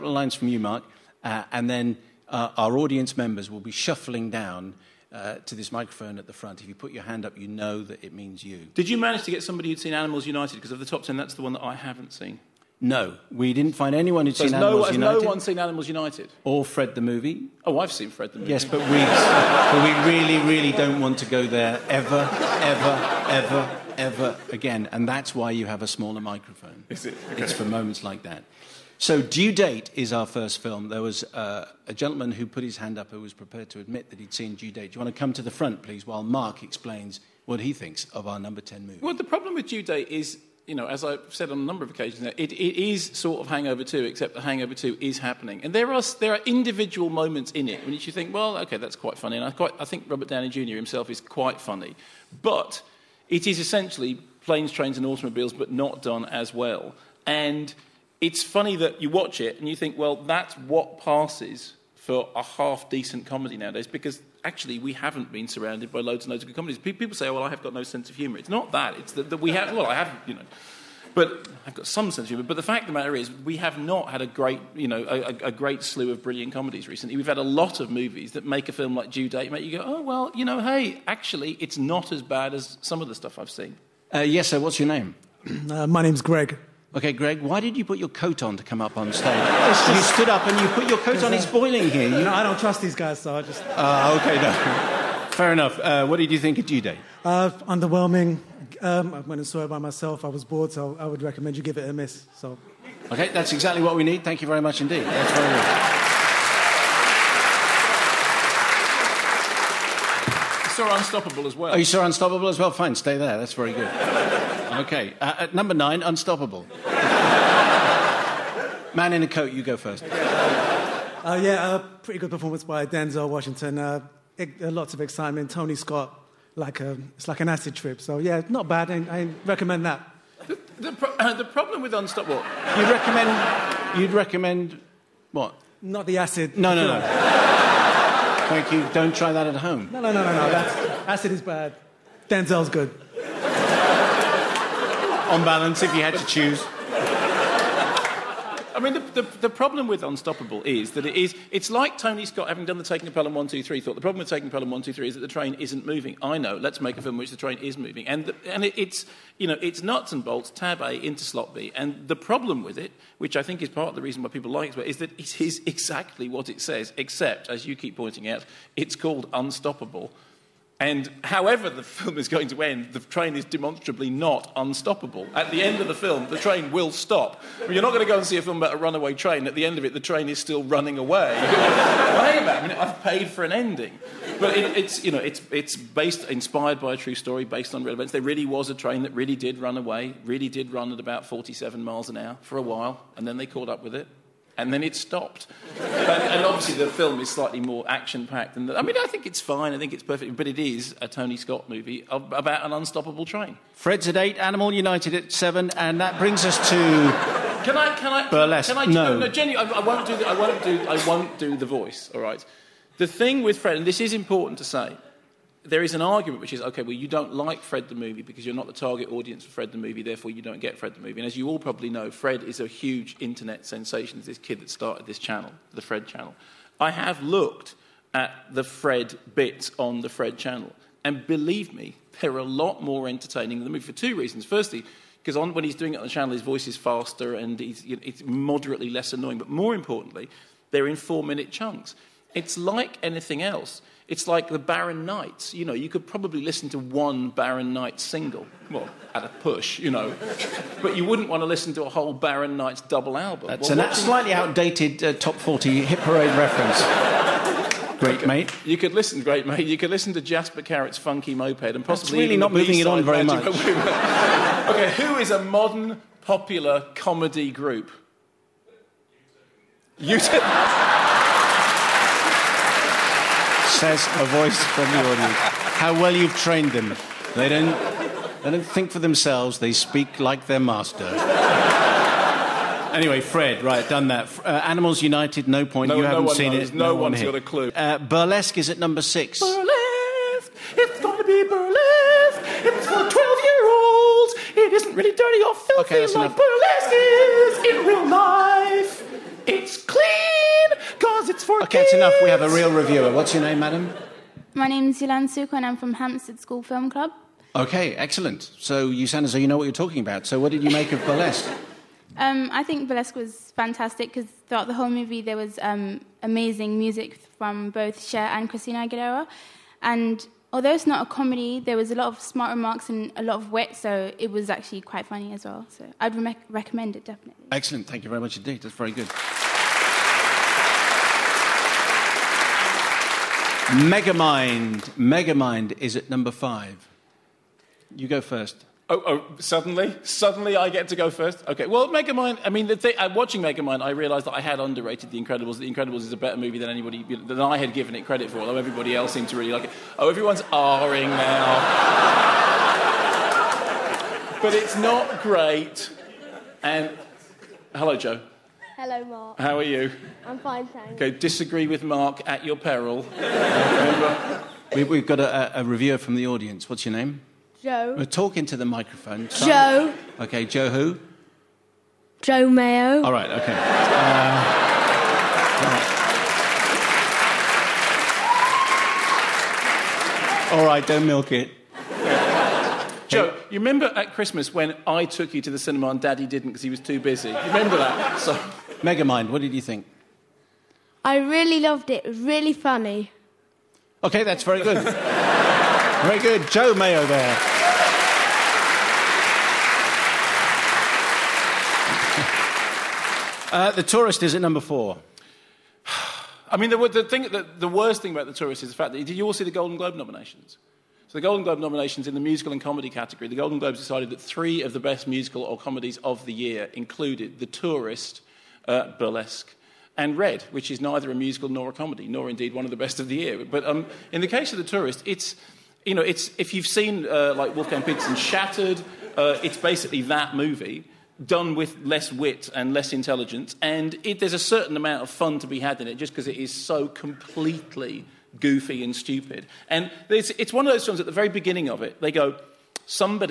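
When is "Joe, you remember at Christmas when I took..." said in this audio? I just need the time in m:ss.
6:23.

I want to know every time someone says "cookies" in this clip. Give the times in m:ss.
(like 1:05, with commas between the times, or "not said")
not said.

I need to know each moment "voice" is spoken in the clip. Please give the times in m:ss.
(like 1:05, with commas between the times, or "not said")
3:31, 3:56, 4:34.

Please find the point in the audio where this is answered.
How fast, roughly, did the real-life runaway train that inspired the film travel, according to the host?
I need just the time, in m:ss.
3:11.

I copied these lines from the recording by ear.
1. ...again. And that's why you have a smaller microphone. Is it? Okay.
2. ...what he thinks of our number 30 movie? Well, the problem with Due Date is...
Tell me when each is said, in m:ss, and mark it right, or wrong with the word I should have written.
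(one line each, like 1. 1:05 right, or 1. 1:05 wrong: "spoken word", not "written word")
1. 0:24 right
2. 0:37 wrong: "10", not "30".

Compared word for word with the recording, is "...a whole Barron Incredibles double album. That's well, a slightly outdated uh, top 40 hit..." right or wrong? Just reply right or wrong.
wrong.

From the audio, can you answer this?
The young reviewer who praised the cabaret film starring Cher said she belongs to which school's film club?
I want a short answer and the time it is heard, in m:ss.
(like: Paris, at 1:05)
Hampstead School, at 5:05.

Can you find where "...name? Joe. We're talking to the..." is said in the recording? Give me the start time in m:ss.
6:06.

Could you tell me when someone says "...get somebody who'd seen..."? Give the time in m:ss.
0:09.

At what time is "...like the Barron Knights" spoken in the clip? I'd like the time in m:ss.
4:04.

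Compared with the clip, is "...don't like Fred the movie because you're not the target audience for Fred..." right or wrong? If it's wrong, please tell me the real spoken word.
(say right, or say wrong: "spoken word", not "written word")
right.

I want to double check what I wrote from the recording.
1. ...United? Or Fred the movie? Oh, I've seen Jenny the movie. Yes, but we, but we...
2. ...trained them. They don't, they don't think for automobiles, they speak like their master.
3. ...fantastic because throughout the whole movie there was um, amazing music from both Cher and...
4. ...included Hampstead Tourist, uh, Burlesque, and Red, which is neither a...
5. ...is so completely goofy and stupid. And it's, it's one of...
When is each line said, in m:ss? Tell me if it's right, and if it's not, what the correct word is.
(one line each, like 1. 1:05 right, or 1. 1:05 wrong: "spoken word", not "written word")
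1. 0:15 wrong: "Fred", not "Jenny"
2. 4:36 wrong: "themselves", not "automobiles"
3. 5:13 right
4. 6:56 wrong: "The", not "Hampstead"
5. 7:16 right.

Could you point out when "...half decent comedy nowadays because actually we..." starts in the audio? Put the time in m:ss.
1:02.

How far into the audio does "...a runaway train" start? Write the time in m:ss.
2:58.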